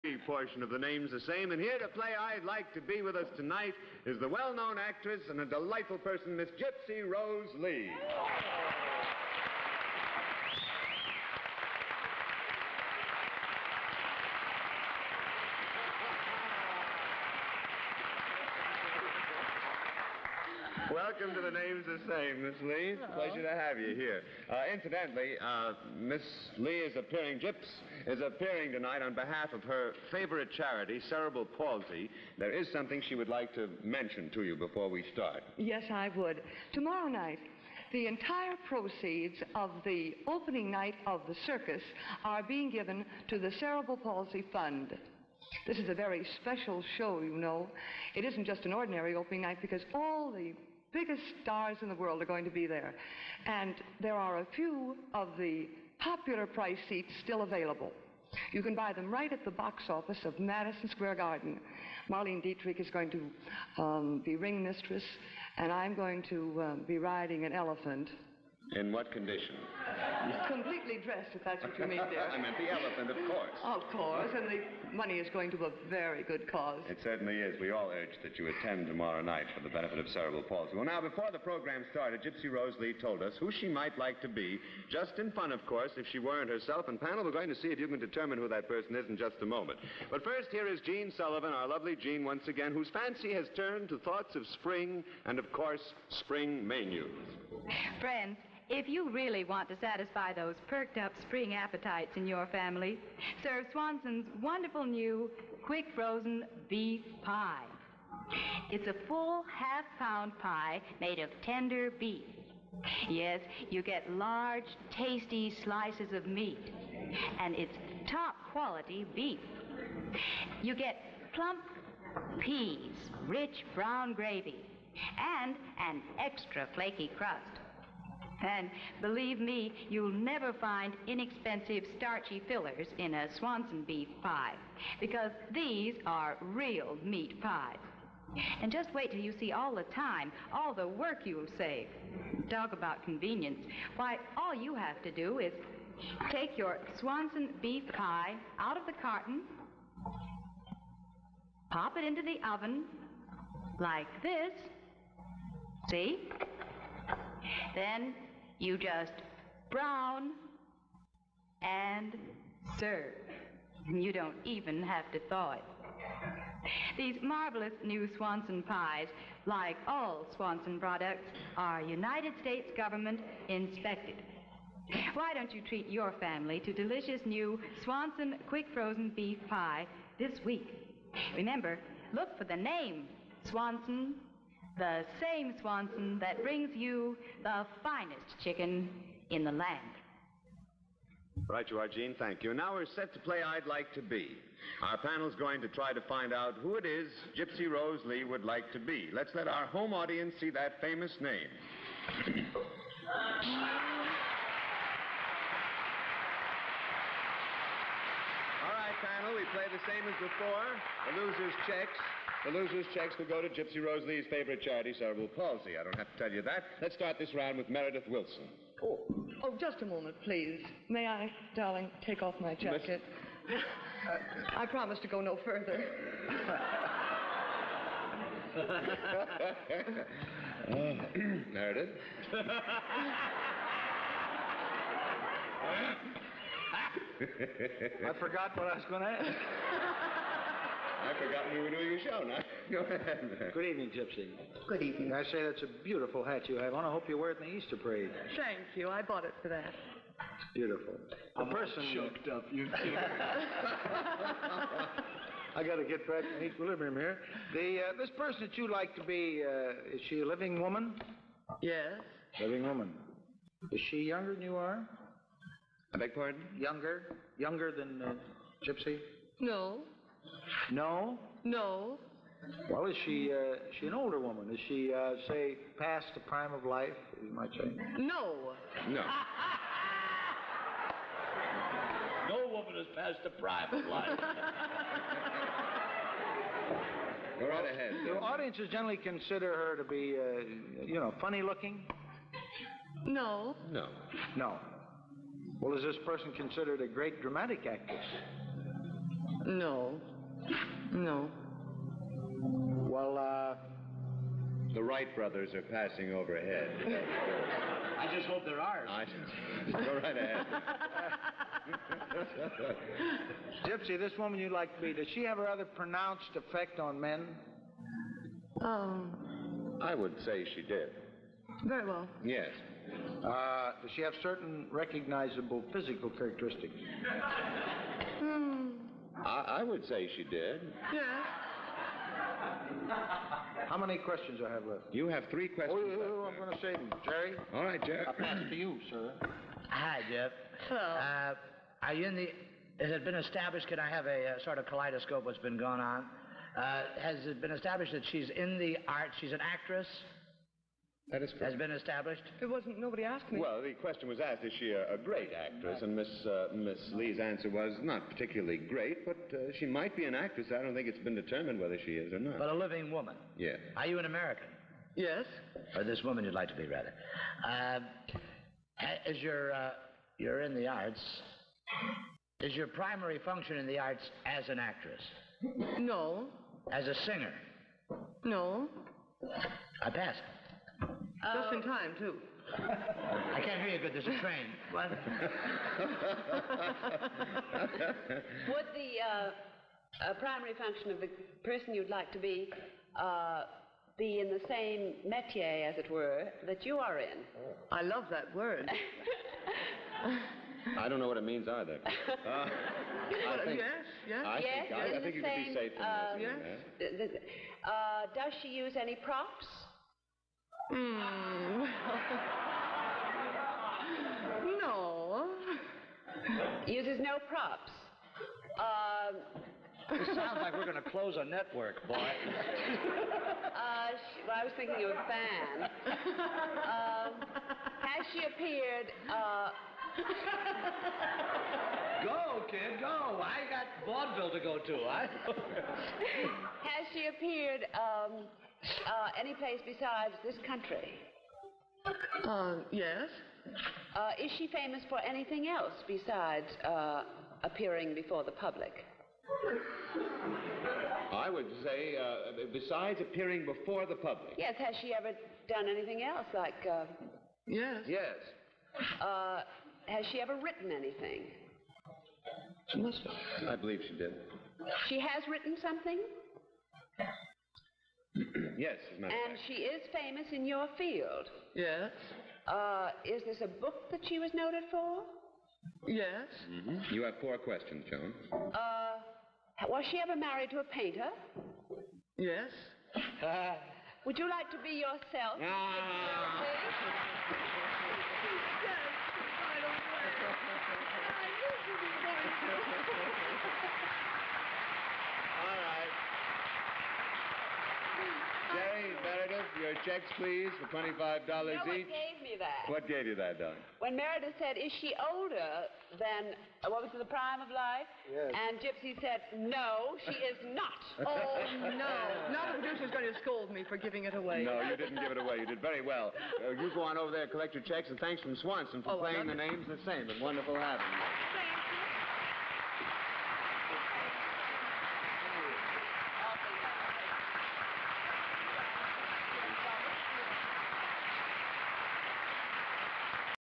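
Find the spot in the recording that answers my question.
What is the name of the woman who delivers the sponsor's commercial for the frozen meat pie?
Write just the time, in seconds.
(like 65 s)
90 s.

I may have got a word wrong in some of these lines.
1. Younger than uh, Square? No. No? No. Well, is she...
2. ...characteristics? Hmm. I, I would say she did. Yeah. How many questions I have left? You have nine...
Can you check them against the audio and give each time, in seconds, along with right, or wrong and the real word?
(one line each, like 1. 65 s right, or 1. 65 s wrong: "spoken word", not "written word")
1. 267 s wrong: "Gypsy", not "Square"
2. 326 s wrong: "three", not "nine".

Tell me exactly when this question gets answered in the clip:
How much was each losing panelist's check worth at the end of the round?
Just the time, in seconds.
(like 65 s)
500 s.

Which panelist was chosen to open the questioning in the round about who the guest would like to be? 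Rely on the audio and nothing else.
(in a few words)
Meredith Willson.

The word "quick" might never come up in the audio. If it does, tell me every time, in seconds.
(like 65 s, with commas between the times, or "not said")
105 s, 178 s.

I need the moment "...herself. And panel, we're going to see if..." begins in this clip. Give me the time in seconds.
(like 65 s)
86 s.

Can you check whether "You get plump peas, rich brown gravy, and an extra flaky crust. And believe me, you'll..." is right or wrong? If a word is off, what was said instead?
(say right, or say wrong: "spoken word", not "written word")
right.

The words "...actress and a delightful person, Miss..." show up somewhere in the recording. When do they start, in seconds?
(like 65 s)
4 s.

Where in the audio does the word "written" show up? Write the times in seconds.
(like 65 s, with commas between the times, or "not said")
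460 s, 465 s.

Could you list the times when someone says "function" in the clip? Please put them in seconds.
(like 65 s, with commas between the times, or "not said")
373 s, 390 s.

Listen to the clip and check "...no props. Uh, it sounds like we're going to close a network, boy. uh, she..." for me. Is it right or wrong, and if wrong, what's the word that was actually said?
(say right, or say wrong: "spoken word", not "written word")
right.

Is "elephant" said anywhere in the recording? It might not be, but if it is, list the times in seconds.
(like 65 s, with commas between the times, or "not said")
67 s, 72 s.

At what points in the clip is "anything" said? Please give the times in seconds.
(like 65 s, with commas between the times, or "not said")
444 s, 455 s, 460 s.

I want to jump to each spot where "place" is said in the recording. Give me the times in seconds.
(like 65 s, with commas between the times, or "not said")
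439 s.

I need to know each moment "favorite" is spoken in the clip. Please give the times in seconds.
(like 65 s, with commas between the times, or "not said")
30 s, 214 s.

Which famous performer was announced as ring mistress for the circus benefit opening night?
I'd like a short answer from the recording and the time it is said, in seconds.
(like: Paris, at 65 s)
Marlene Dietrich, at 62 s.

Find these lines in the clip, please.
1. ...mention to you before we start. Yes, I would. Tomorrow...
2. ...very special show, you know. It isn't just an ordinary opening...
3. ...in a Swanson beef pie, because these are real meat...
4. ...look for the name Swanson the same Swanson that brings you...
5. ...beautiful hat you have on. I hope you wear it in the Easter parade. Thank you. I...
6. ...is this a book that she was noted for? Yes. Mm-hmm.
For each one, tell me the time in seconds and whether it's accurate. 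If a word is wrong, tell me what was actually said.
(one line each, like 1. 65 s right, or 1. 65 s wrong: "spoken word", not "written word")
1. 33 s right
2. 45 s right
3. 132 s right
4. 182 s right
5. 245 s right
6. 473 s right.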